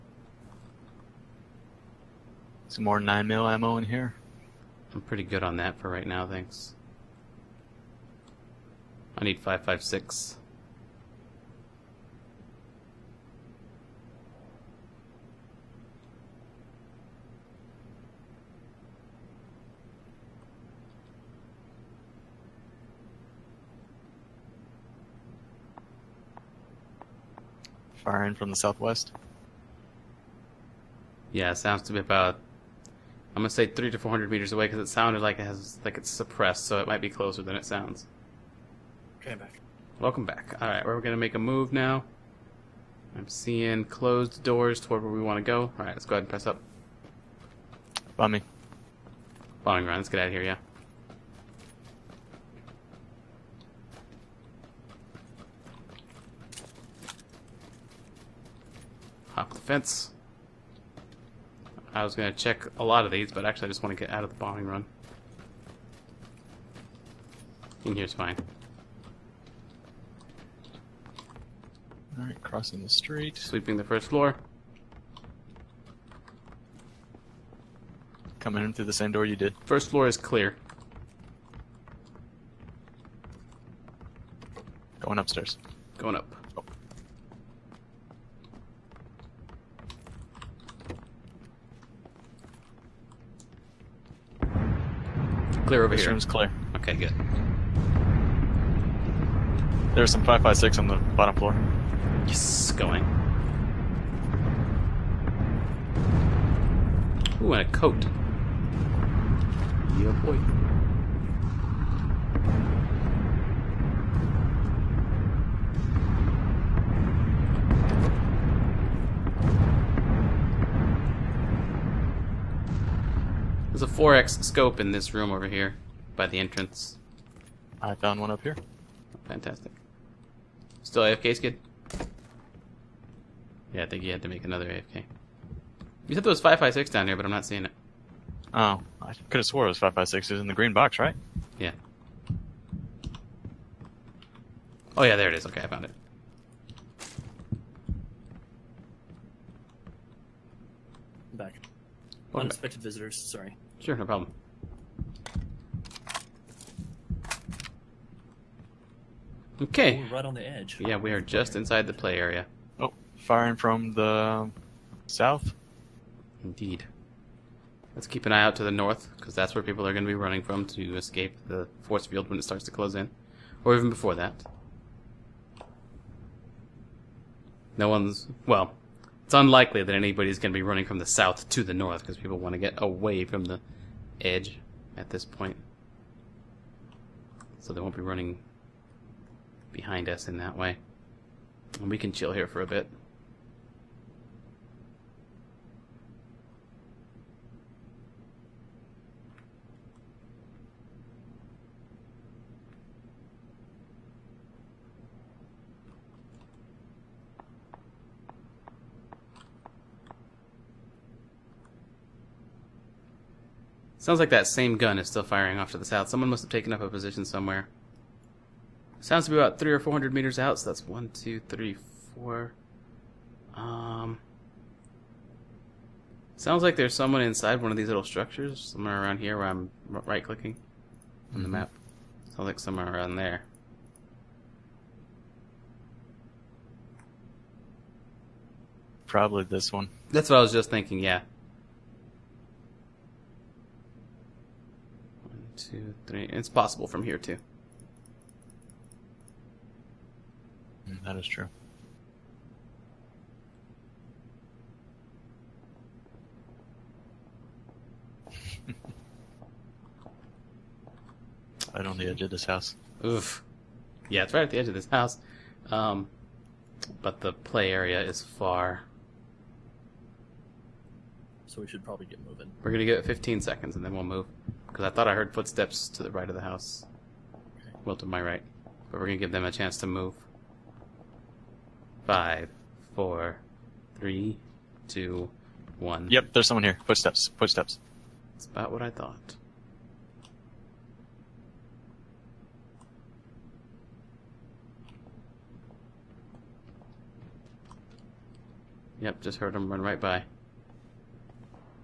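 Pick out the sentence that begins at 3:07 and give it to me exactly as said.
So they won't be running behind us in that way.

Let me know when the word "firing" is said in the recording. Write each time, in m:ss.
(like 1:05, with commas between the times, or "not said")
2:43, 3:35.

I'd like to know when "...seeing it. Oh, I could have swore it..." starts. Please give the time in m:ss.
2:17.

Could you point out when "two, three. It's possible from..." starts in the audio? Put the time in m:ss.
4:05.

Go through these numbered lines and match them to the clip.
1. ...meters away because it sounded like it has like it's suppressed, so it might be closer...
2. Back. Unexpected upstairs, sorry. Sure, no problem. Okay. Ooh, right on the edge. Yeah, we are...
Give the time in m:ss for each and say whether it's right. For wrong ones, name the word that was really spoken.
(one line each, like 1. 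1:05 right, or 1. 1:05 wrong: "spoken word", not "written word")
1. 0:34 right
2. 2:31 wrong: "visitors", not "upstairs".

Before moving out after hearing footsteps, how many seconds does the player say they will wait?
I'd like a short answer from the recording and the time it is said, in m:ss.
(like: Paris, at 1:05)
15, at 4:33.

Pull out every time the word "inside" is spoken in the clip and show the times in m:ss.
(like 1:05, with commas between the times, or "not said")
2:41, 3:47.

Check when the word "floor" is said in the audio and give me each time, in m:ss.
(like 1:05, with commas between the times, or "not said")
1:14, 1:19, 1:41.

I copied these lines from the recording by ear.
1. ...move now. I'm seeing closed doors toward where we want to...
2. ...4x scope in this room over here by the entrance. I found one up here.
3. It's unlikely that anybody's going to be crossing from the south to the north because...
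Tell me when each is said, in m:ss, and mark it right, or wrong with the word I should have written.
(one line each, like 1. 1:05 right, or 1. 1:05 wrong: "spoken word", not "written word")
1. 0:41 right
2. 2:03 right
3. 2:59 wrong: "running", not "crossing".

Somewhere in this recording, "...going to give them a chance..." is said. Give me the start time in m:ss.
4:39.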